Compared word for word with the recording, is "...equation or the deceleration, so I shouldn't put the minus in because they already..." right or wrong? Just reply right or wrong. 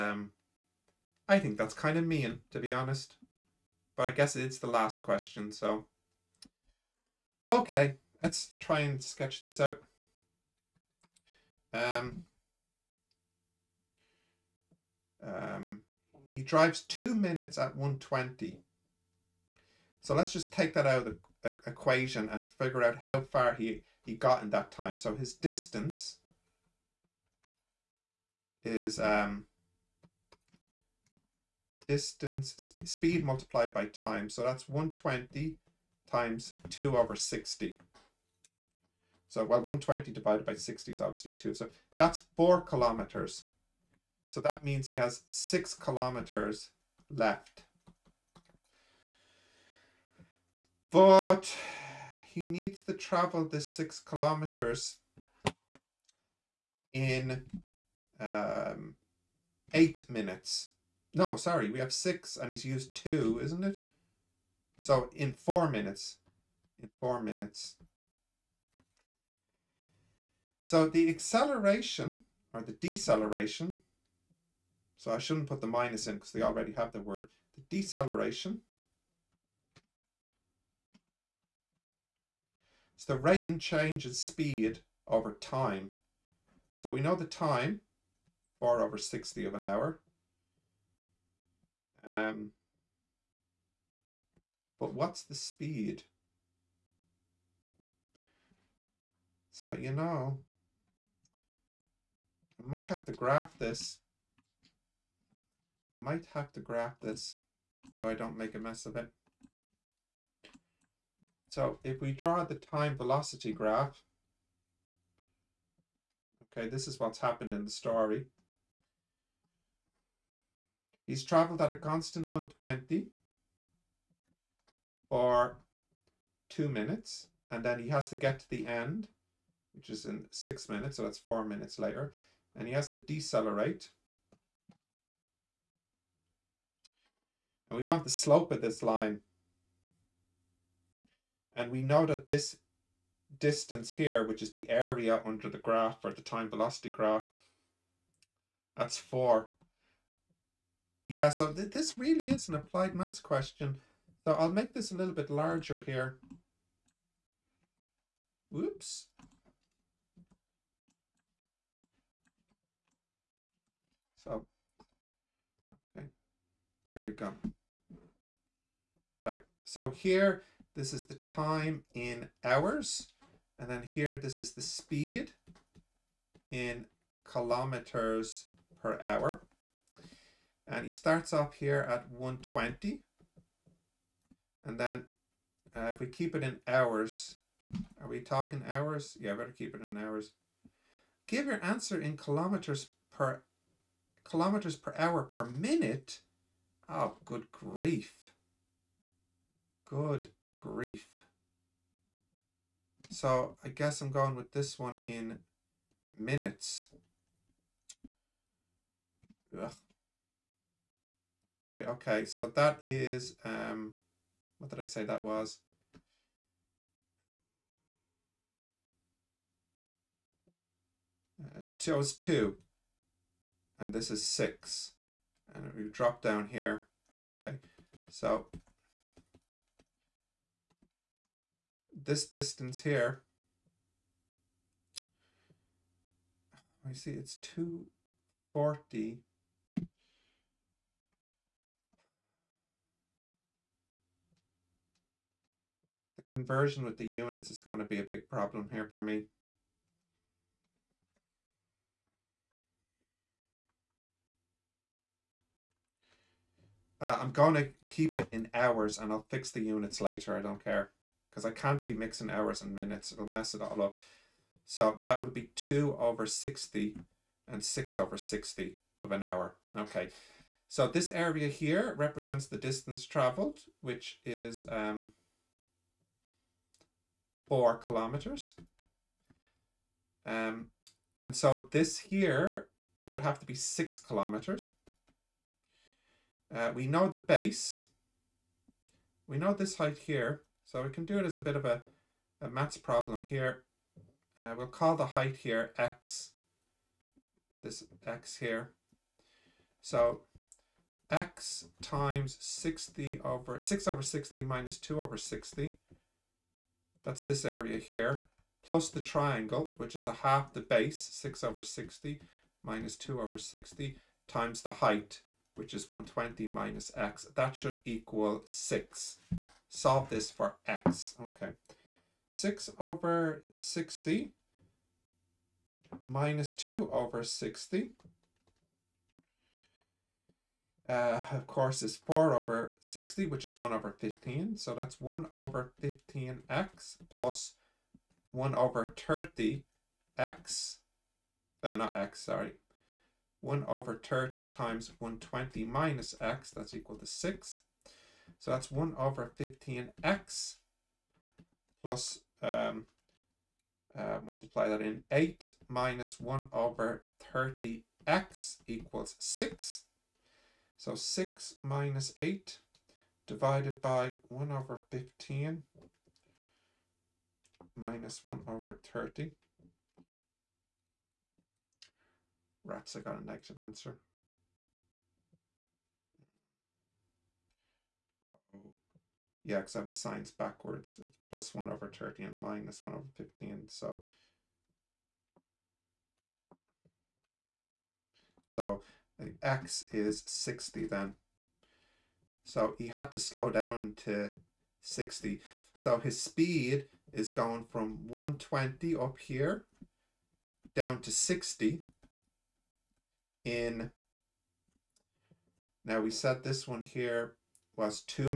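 wrong.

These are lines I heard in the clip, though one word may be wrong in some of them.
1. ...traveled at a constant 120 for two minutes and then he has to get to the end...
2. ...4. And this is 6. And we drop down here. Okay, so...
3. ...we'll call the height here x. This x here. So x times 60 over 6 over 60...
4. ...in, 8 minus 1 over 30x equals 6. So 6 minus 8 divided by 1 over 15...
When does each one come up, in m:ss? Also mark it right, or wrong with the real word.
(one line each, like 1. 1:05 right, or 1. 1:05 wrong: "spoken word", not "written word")
1. 2:01 right
2. 3:42 wrong: "2", not "4"
3. 4:54 right
4. 5:54 right.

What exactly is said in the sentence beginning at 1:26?
So we know the time, 4 over 60 of an hour.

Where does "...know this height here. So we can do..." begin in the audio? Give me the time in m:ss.
4:49.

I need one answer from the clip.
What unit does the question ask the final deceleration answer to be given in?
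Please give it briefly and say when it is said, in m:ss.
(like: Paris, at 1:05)
kilometers per hour per minute, at 3:14.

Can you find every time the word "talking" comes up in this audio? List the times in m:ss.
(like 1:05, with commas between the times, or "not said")
3:08.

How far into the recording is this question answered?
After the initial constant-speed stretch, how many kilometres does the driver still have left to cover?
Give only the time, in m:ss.
0:45.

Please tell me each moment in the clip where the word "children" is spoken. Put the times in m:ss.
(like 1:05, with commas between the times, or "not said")
not said.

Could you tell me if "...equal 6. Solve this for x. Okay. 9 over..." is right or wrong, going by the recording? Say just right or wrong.
wrong.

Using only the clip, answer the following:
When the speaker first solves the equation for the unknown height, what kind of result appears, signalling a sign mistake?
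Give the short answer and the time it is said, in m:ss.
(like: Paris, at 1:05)
a negative answer, at 6:13.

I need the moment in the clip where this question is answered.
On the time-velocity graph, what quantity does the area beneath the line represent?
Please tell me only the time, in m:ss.
4:32.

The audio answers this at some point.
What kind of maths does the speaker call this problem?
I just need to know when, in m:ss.
2:32.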